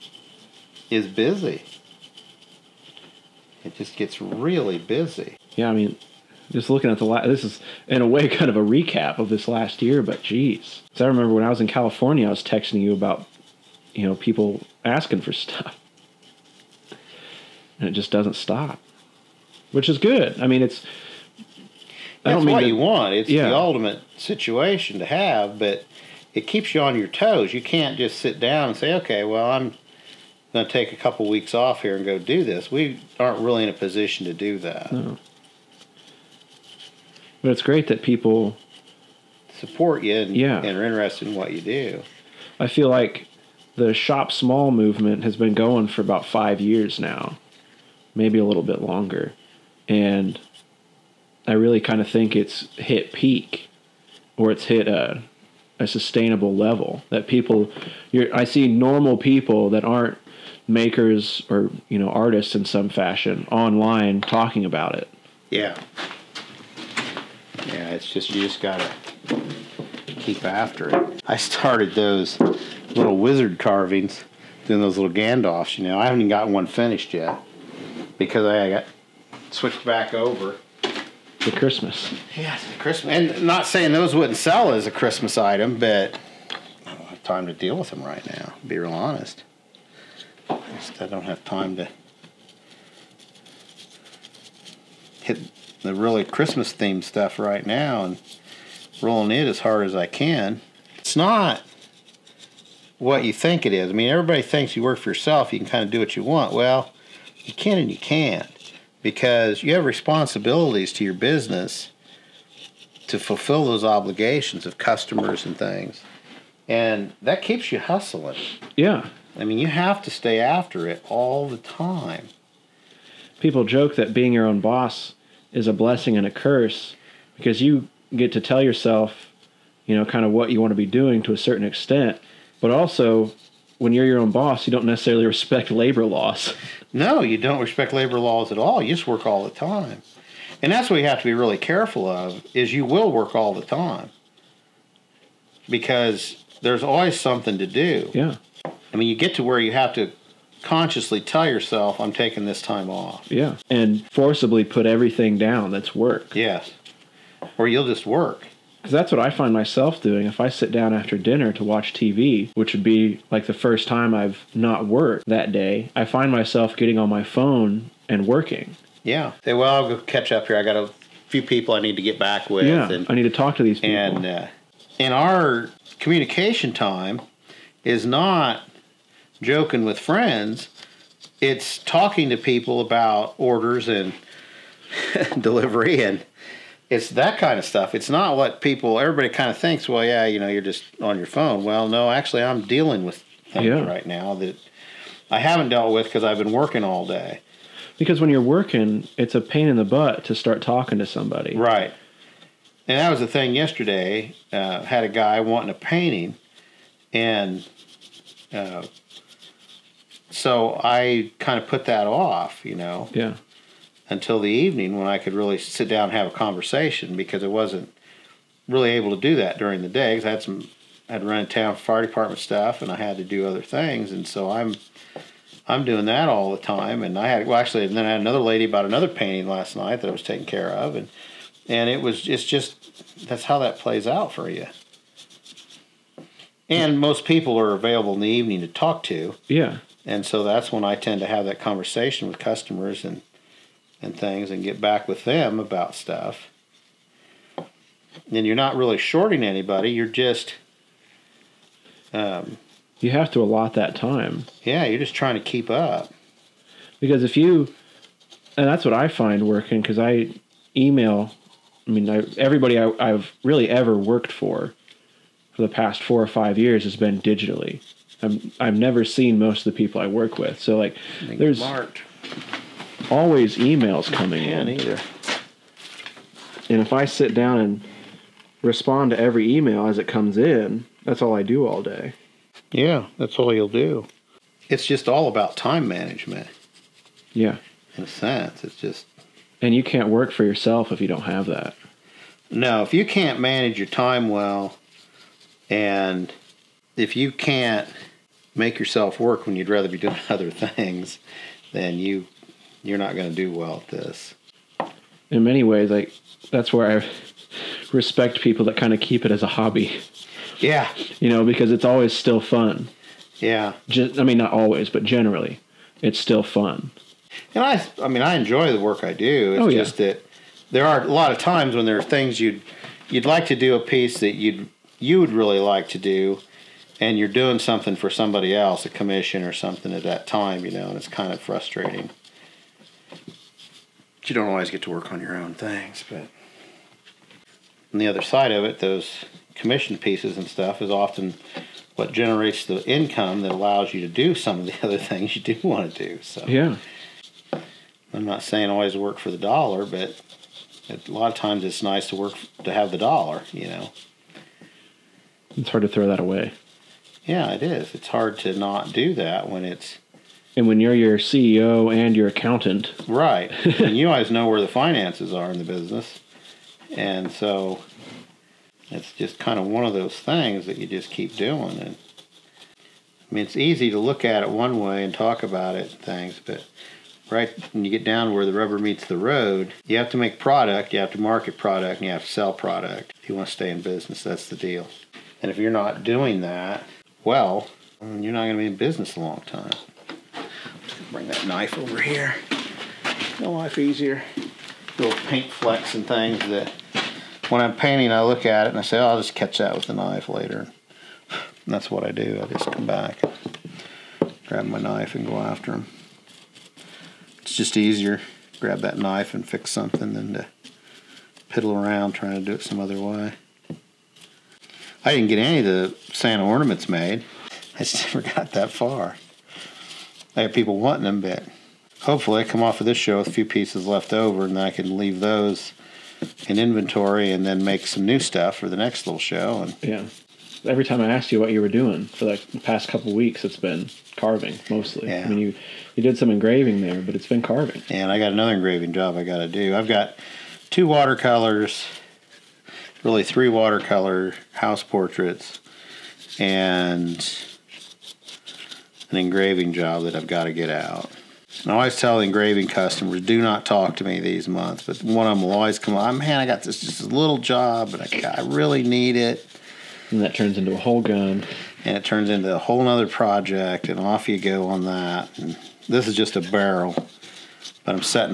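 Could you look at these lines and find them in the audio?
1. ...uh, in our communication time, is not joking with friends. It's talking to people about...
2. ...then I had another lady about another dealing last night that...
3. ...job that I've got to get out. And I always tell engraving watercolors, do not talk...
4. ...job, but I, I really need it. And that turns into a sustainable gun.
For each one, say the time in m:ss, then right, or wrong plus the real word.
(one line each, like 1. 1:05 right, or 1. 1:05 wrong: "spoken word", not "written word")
1. 2:54 right
2. 3:47 wrong: "painting", not "dealing"
3. 7:29 wrong: "customers", not "watercolors"
4. 7:37 wrong: "whole", not "sustainable".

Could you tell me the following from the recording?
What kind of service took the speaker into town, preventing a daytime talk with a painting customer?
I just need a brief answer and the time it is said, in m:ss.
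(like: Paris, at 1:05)
fire department, at 3:41.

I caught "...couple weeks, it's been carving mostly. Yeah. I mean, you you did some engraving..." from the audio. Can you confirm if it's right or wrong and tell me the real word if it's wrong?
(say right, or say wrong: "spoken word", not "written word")
right.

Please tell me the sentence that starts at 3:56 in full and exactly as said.
And most people are available in the evening to talk to.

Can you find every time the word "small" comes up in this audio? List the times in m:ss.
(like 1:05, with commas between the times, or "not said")
0:44.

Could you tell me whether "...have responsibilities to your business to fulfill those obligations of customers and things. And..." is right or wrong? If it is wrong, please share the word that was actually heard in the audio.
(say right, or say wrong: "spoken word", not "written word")
right.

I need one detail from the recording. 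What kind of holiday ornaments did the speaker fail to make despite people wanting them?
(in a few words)
Santa ornaments.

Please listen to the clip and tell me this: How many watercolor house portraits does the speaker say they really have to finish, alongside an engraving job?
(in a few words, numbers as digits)
3.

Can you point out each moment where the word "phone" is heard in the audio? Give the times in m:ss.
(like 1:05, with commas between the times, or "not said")
2:47, 3:11.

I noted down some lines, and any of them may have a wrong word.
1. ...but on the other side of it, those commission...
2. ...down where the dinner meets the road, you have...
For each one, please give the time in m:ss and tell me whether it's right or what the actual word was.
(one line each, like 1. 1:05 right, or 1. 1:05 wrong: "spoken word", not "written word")
1. 5:36 right
2. 6:18 wrong: "rubber", not "dinner".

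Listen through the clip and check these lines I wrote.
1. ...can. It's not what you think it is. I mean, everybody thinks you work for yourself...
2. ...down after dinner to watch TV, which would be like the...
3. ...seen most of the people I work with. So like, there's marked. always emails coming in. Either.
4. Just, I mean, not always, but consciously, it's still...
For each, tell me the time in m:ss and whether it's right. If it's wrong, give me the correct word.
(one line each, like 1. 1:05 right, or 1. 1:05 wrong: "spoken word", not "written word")
1. 1:40 right
2. 2:40 right
3. 4:29 right
4. 5:13 wrong: "generally", not "consciously".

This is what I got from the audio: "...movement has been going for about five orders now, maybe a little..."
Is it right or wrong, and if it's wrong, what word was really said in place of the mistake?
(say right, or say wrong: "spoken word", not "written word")
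wrong: "years", not "orders".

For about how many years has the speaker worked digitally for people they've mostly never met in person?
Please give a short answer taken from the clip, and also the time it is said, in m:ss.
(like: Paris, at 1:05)
4 or 5, at 4:26.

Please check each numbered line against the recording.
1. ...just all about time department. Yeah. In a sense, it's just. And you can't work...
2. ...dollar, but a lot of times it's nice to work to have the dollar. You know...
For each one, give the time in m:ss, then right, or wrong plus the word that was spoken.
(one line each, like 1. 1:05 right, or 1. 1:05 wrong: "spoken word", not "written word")
1. 4:44 wrong: "management", not "department"
2. 5:49 right.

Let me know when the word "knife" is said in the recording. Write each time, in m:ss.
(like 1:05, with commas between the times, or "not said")
6:31, 6:39, 6:44, 6:48.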